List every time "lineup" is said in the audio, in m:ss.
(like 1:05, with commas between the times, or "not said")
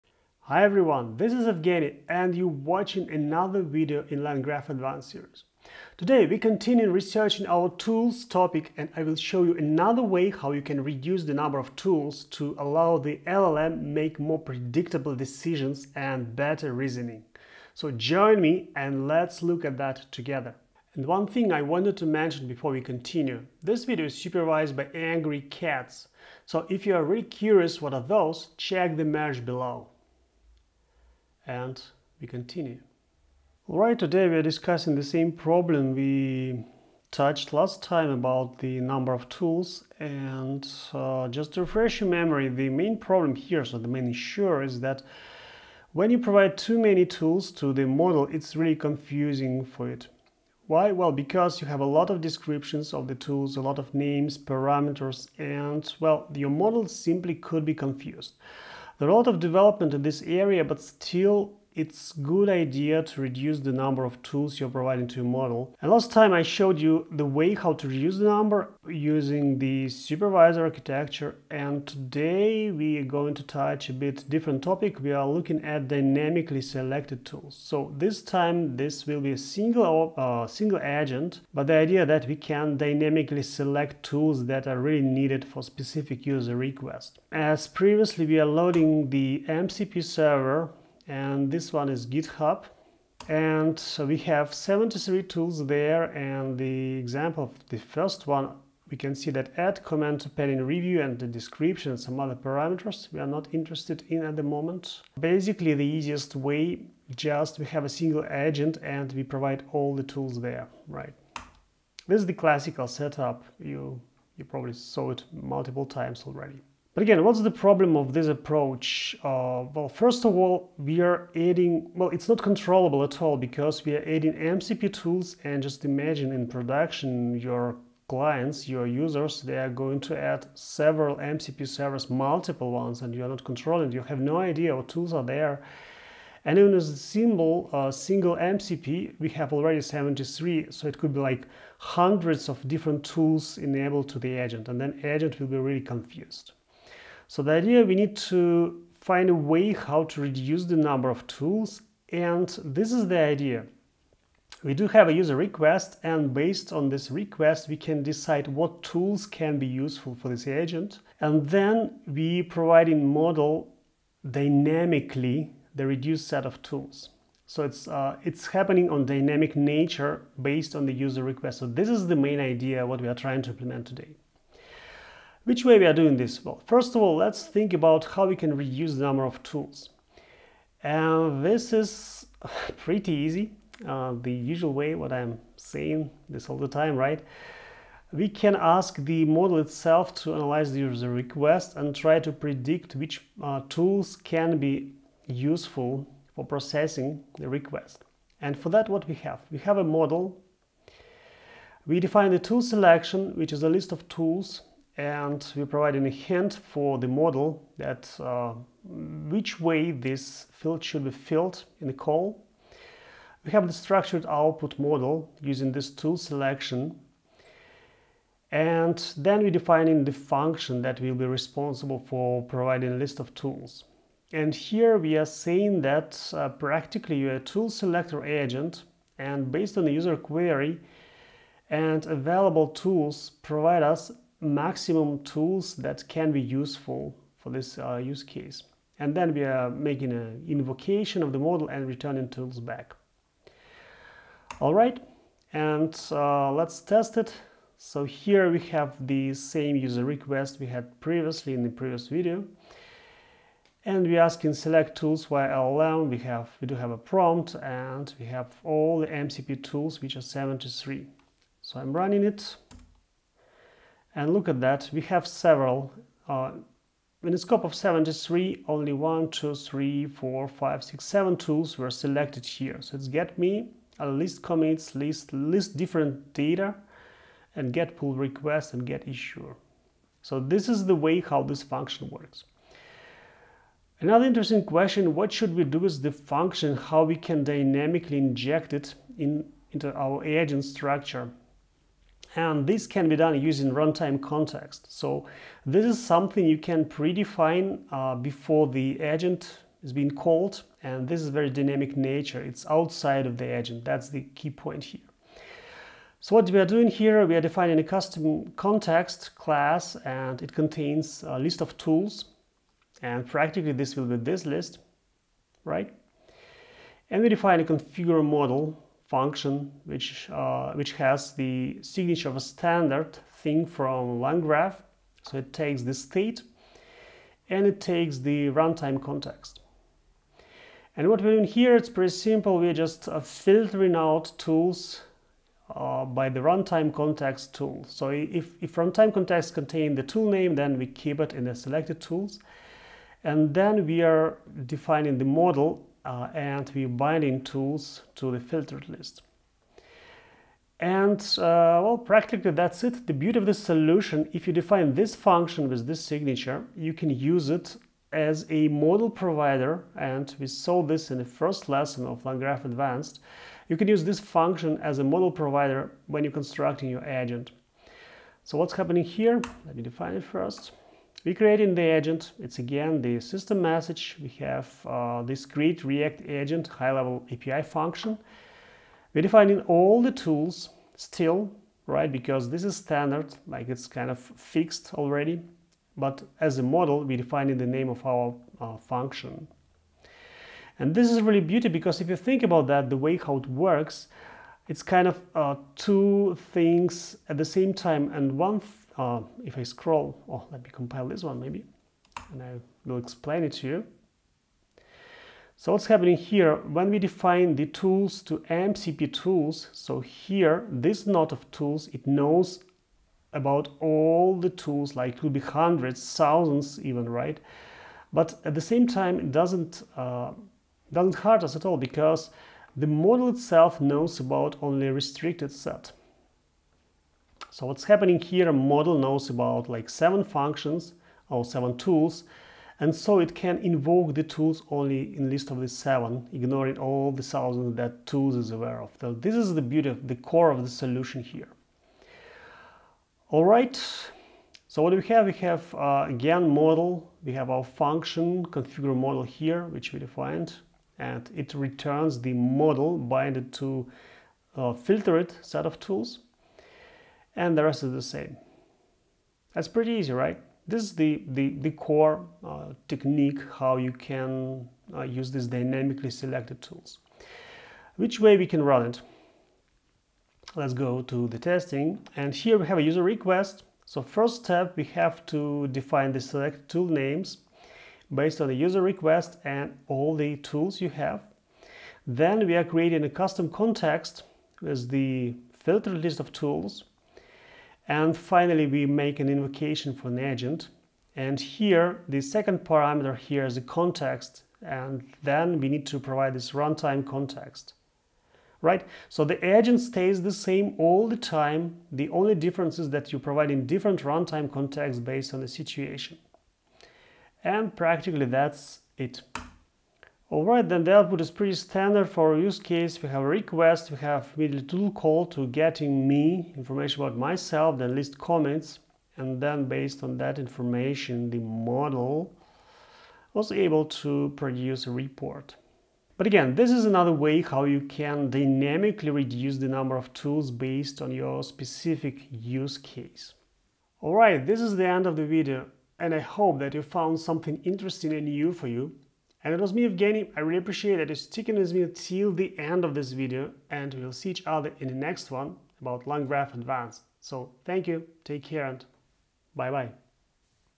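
not said.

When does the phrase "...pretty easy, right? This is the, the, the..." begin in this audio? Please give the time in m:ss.
7:39.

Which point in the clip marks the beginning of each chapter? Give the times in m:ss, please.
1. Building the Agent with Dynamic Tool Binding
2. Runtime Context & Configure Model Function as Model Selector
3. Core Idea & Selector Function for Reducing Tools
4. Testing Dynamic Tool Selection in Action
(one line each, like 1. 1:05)
1. 6:10
2. 4:43
3. 2:27
4. 7:47.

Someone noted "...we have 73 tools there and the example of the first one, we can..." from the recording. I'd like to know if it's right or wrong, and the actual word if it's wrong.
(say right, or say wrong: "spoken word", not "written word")
right.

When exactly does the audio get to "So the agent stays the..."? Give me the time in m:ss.
8:19.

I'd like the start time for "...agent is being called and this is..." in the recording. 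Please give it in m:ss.
4:59.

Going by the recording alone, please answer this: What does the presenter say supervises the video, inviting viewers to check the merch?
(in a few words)
Angry Cats.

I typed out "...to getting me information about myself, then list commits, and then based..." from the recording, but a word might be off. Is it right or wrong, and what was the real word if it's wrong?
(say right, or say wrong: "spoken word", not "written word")
right.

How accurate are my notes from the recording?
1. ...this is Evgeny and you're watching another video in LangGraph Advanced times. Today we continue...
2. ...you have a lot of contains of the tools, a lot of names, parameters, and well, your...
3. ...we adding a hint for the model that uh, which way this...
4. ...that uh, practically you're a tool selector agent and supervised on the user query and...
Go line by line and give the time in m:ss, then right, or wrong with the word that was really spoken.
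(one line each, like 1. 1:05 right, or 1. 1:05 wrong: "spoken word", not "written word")
1. 0:01 wrong: "series", not "times"
2. 0:51 wrong: "descriptions", not "contains"
3. 3:25 wrong: "providing", not "adding"
4. 3:45 wrong: "based", not "supervised".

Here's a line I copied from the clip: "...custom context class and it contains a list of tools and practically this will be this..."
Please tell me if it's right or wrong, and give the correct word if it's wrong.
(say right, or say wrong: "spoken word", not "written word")
right.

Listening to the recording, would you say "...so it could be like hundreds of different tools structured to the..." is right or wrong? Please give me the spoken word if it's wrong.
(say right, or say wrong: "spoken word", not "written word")
wrong: "enabled", not "structured".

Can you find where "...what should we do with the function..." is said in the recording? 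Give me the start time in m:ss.
4:45.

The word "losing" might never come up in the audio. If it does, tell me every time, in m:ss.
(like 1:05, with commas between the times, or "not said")
not said.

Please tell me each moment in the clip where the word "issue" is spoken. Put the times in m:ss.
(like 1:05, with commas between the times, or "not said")
0:44, 4:39.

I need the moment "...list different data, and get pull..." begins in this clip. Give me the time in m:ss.
4:35.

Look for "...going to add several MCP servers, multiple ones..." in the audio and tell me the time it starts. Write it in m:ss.
2:09.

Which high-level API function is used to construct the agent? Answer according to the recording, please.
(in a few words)
create react agent.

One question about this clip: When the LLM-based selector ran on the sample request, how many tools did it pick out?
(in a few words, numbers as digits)
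7.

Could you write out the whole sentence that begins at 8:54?
Alright, this is the end of the video, and I hope that you found something interesting and new for you.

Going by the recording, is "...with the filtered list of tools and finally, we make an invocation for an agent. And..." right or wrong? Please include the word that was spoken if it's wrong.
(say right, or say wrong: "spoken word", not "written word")
right.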